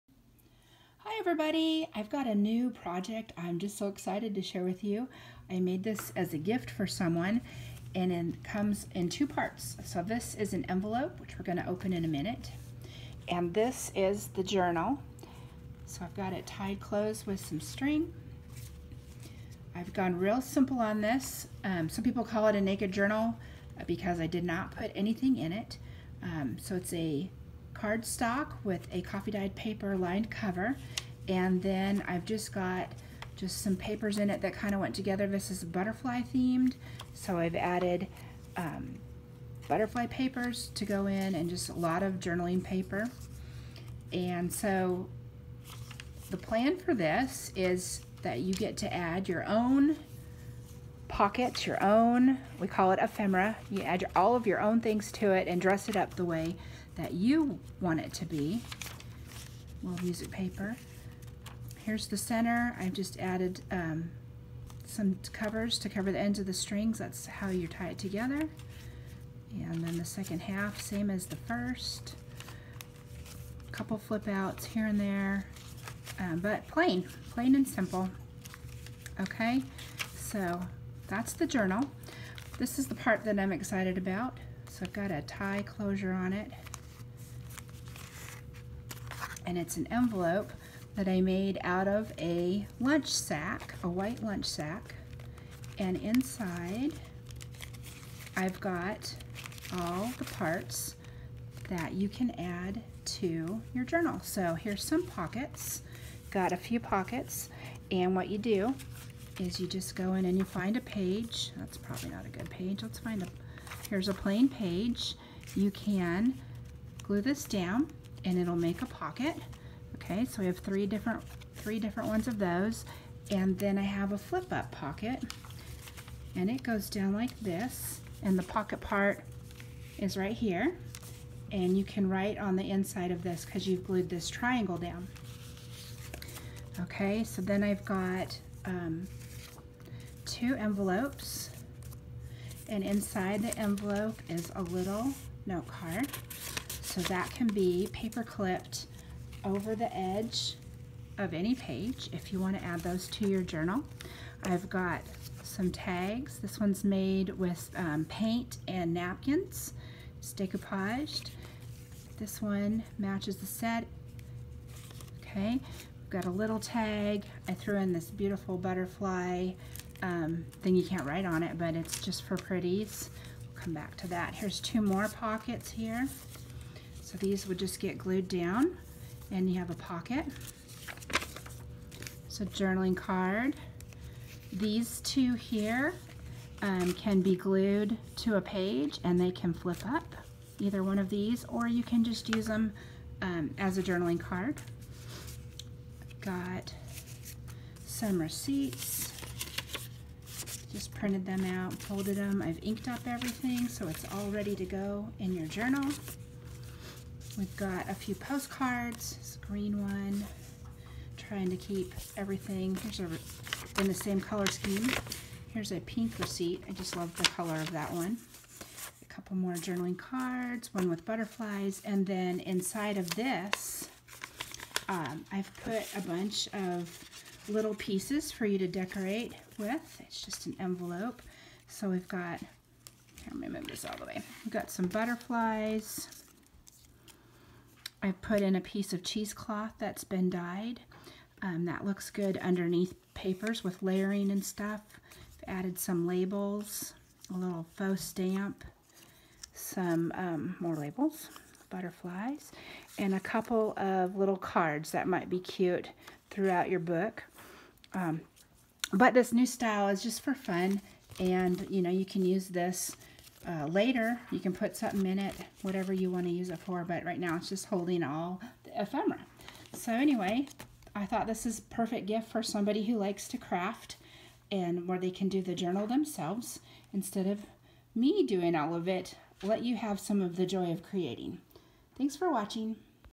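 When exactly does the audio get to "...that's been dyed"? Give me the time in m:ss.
3:59.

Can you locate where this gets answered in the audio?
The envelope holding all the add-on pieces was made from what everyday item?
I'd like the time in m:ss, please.
1:33.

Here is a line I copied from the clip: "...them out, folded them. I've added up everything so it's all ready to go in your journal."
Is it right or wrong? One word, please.
wrong.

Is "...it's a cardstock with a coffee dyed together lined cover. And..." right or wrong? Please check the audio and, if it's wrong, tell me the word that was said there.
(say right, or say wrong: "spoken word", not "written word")
wrong: "paper", not "together".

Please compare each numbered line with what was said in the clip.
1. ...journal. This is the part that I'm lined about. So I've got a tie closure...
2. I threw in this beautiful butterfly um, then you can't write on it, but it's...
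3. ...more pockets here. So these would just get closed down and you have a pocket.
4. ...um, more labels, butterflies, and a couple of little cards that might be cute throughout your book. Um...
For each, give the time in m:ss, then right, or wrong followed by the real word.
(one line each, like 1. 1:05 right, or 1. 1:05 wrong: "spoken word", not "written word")
1. 1:21 wrong: "excited", not "lined"
2. 2:47 right
3. 2:54 wrong: "glued", not "closed"
4. 4:10 right.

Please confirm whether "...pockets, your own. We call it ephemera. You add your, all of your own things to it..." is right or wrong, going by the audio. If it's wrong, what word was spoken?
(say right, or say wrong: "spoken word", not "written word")
right.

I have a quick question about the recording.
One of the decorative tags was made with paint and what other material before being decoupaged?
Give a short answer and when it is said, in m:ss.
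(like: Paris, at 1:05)
Napkins, at 2:38.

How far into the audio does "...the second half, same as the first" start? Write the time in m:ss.
1:09.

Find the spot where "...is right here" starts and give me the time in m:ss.
2:09.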